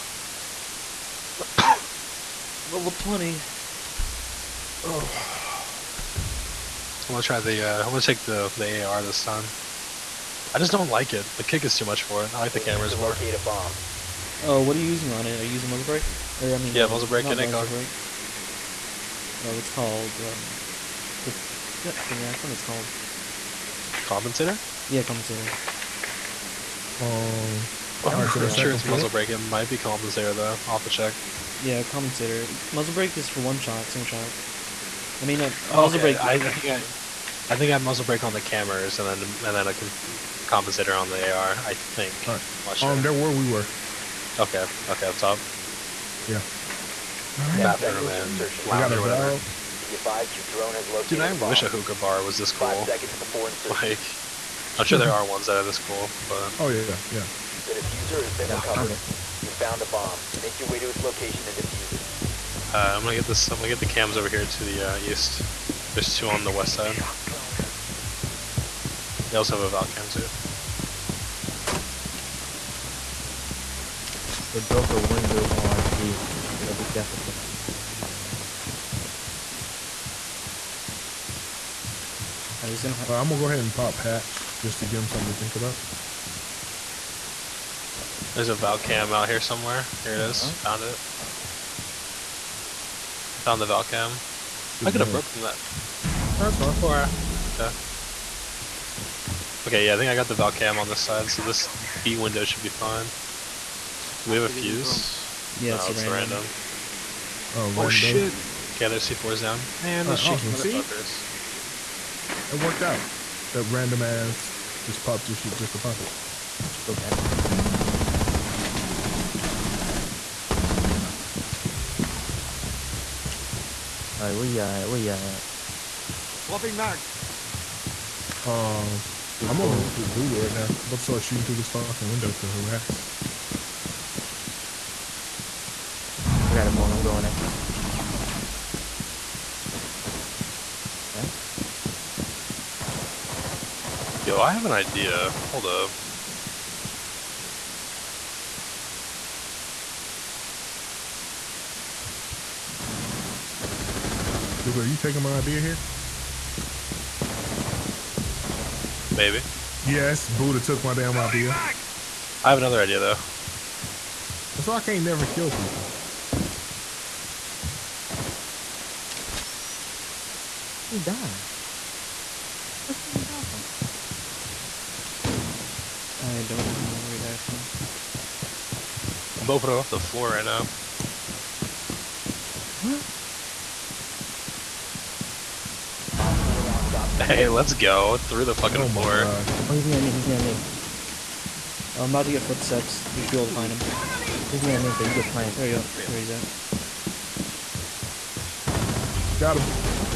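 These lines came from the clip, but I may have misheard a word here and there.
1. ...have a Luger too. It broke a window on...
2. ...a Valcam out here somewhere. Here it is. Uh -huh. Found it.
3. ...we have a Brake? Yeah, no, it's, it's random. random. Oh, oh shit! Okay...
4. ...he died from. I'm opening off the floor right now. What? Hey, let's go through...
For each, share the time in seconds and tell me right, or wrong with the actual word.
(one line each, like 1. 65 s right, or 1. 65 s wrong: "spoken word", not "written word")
1. 69 s wrong: "Valcam", not "Luger"
2. 88 s right
3. 104 s wrong: "Fuze", not "Brake"
4. 177 s right.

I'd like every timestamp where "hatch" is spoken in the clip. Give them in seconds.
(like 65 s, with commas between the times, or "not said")
83 s.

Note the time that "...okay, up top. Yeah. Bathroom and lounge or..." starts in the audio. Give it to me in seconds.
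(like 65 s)
44 s.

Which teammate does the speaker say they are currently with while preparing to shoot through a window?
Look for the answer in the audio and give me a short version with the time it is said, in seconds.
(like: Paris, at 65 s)
Luger, at 130 s.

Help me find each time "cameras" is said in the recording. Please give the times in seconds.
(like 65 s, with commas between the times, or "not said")
12 s, 38 s.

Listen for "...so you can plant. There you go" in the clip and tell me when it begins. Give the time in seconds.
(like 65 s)
194 s.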